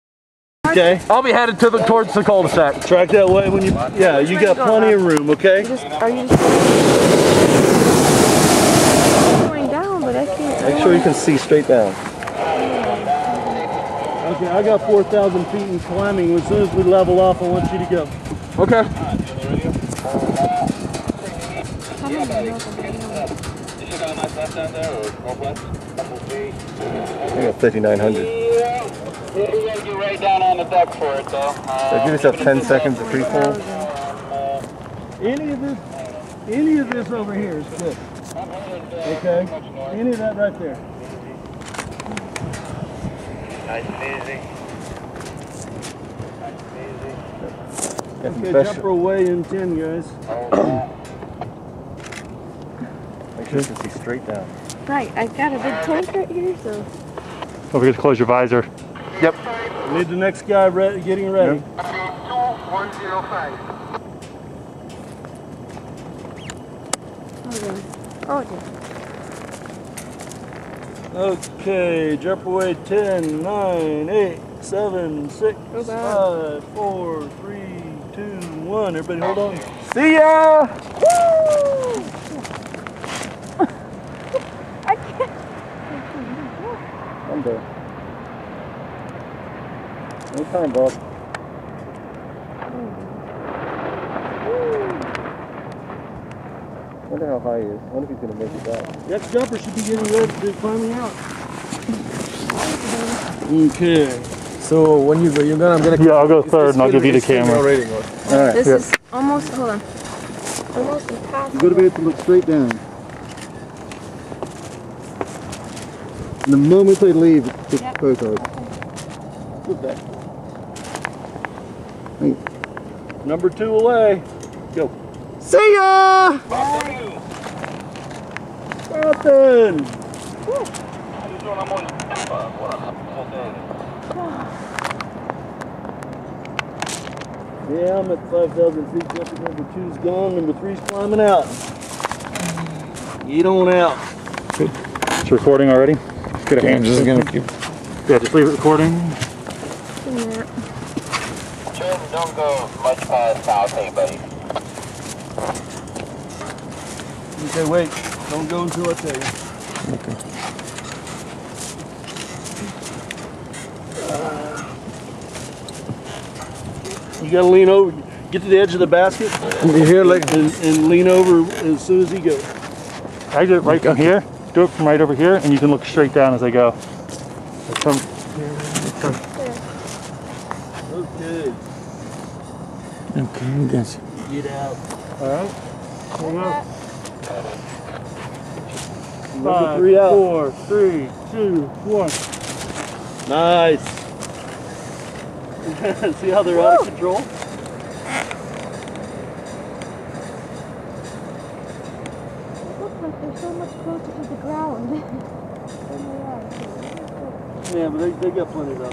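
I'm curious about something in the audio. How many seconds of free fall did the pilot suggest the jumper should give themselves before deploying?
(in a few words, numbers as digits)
10 seconds.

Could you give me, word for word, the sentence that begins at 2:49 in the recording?
You here, like, and, and, lean over as soon as he goes.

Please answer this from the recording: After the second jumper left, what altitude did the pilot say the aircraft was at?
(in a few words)
5,000 feet.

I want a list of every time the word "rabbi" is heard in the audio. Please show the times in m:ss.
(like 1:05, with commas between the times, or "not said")
not said.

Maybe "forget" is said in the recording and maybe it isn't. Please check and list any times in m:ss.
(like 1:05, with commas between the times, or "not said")
0:57.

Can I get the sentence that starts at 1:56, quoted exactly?
And the moment they leave, it's yep.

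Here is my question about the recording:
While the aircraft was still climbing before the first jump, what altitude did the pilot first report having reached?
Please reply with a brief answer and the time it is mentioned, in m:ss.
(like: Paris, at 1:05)
4,000 feet, at 0:14.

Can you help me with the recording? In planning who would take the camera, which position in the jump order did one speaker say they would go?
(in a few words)
third.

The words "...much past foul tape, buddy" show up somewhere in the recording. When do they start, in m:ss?
2:32.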